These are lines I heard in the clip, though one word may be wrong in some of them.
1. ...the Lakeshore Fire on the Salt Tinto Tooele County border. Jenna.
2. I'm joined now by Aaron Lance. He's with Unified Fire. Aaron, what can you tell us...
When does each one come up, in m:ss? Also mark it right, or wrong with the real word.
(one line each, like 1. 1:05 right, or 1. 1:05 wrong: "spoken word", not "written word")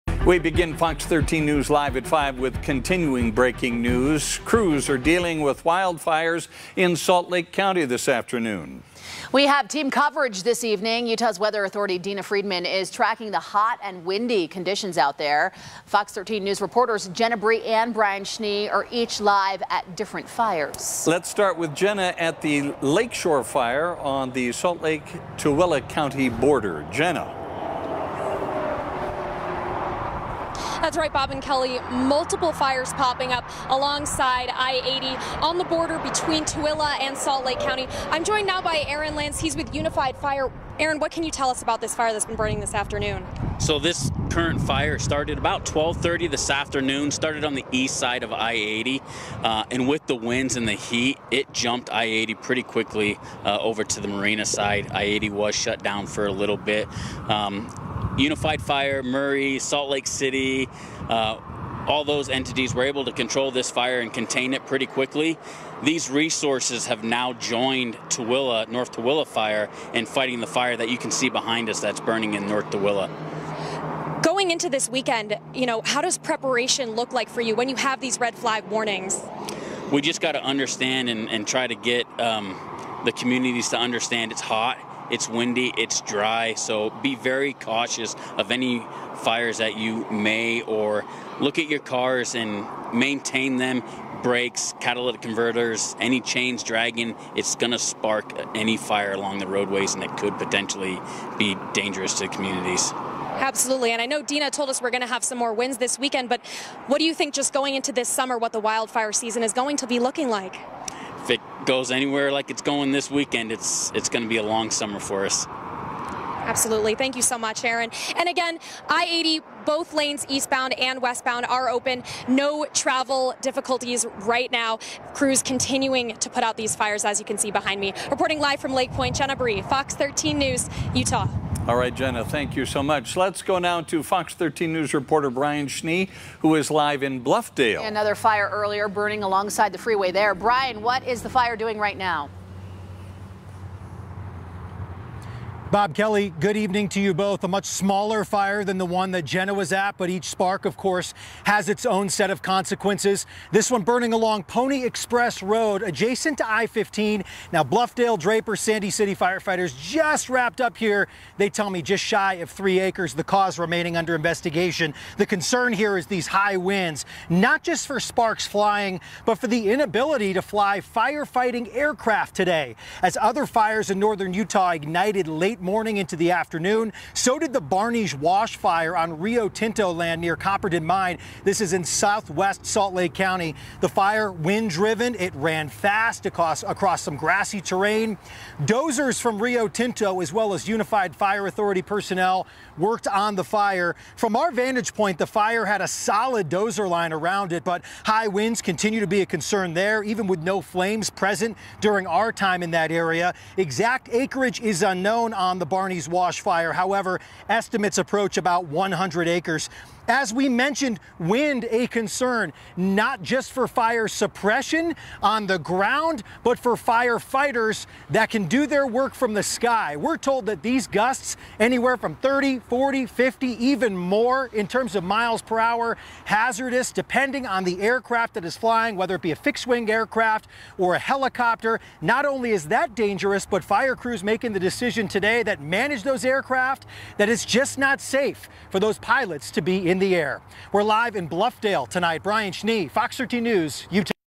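1. 0:22 wrong: "Lake", not "Tinto"
2. 0:38 right.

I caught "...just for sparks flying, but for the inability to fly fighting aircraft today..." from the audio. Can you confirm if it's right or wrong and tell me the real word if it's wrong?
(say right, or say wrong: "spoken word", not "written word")
wrong: "firefighting", not "fighting".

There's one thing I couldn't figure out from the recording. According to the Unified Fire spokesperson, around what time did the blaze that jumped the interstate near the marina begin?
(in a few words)
12:30.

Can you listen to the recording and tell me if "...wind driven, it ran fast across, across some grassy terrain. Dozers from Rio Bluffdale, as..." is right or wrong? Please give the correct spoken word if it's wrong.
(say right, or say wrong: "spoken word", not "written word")
wrong: "Tinto", not "Bluffdale".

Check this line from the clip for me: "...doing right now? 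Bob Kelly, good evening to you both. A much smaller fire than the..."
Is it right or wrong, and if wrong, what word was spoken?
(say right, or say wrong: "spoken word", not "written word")
right.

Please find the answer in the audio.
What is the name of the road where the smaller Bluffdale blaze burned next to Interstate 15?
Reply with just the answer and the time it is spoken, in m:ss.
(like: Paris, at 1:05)
Pony Express Road, at 2:34.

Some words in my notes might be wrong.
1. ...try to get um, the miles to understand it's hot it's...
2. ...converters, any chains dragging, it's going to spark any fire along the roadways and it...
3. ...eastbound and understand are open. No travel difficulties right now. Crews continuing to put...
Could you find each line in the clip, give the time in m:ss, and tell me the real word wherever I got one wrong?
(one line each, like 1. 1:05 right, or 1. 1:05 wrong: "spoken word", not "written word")
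1. 1:21 wrong: "communities", not "miles"
2. 1:35 right
3. 2:00 wrong: "westbound", not "understand".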